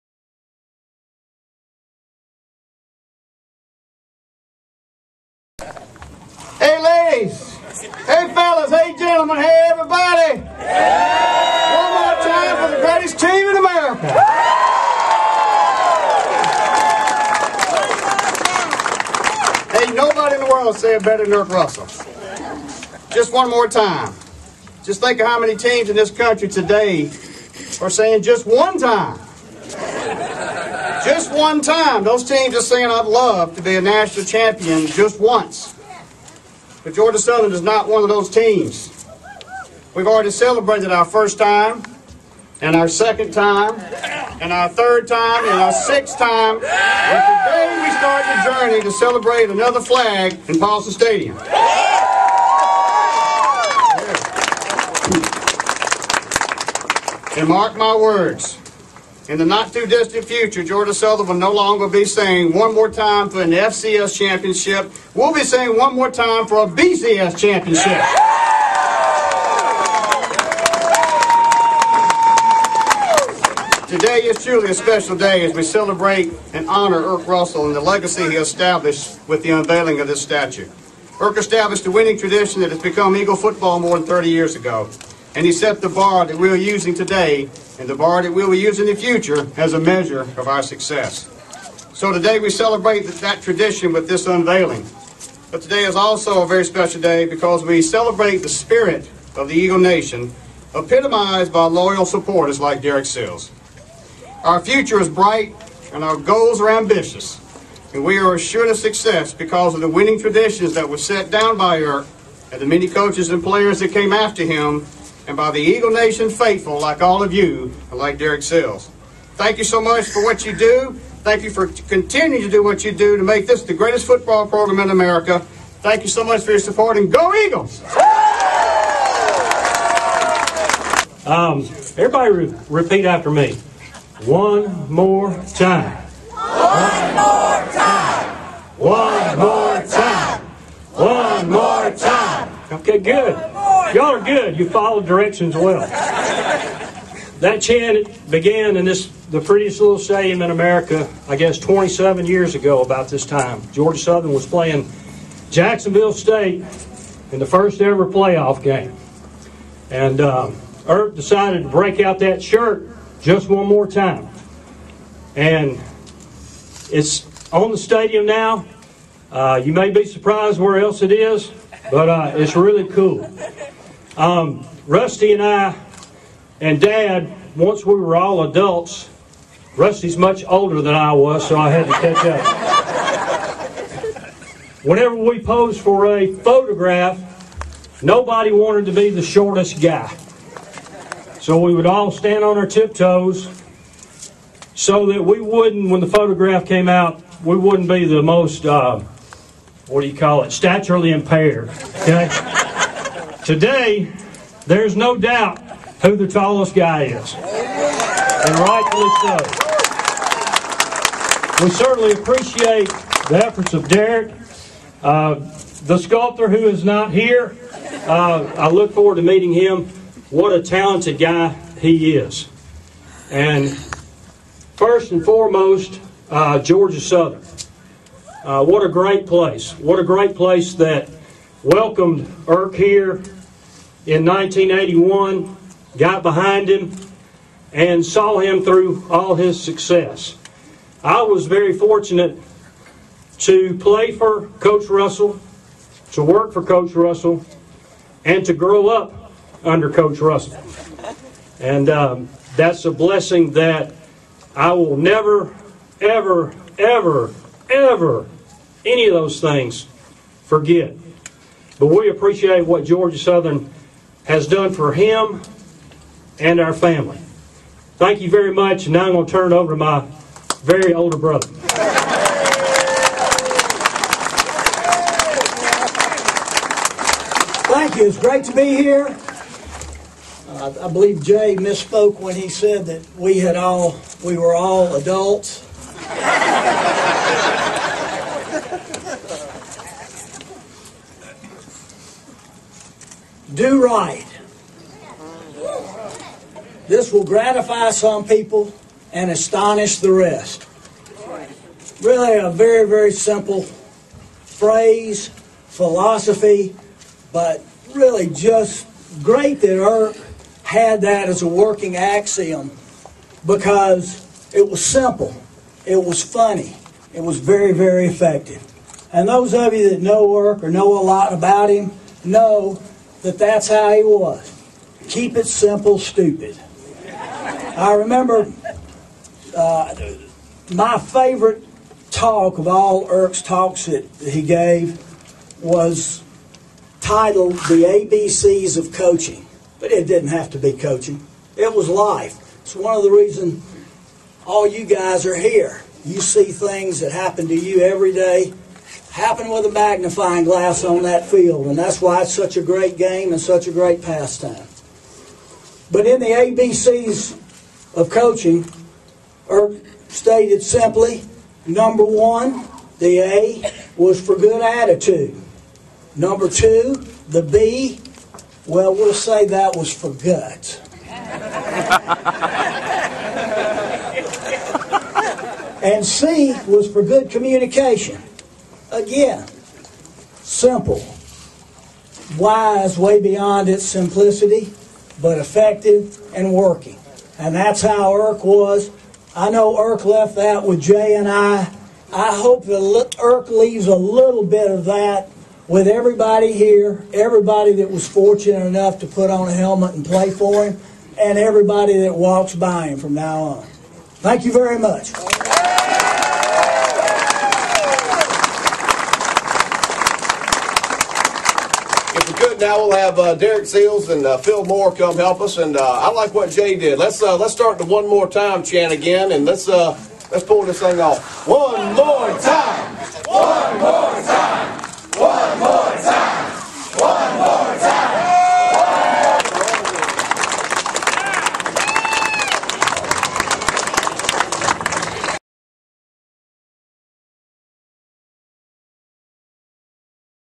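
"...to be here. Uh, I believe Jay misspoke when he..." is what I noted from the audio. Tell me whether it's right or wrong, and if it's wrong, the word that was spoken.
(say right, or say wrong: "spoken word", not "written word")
right.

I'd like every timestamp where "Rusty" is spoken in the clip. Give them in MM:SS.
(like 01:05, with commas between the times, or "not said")
02:54, 02:59.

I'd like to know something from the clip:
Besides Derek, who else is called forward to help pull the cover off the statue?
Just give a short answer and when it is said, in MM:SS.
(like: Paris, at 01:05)
Phil Moore, at 06:54.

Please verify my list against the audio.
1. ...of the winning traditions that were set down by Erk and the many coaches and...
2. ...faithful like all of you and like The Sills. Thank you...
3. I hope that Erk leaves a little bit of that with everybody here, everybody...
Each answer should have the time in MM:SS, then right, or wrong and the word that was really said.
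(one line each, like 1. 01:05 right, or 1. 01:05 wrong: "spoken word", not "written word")
1. 01:49 right
2. 01:56 wrong: "Derek", not "The"
3. 06:32 right.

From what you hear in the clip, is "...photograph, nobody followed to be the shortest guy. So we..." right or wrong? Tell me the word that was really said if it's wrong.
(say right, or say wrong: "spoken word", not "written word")
wrong: "wanted", not "followed".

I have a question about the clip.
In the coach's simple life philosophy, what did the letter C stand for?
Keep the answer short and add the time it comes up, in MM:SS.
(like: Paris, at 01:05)
good communication, at 06:17.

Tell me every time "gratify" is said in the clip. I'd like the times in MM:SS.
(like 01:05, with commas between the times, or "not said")
04:57.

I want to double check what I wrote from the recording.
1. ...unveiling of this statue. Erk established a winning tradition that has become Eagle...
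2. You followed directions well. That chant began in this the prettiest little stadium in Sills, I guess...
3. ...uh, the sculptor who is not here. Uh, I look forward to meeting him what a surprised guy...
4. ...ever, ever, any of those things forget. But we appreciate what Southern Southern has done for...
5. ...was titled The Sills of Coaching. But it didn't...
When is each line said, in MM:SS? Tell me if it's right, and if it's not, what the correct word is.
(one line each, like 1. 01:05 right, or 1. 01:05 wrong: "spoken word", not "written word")
1. 01:19 right
2. 02:24 wrong: "America", not "Sills"
3. 03:35 wrong: "talented", not "surprised"
4. 04:16 wrong: "Georgia", not "Southern"
5. 05:35 wrong: "ABCs", not "Sills".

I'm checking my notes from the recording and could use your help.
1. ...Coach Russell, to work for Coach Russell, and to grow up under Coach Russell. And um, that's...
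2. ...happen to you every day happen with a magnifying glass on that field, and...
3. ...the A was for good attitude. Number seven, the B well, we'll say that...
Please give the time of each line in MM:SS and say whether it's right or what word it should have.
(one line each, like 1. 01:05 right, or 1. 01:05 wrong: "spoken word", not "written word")
1. 04:04 right
2. 05:47 right
3. 06:02 wrong: "two", not "seven".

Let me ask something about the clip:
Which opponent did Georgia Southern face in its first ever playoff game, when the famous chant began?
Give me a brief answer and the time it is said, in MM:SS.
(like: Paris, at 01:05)
Jacksonville State, at 02:35.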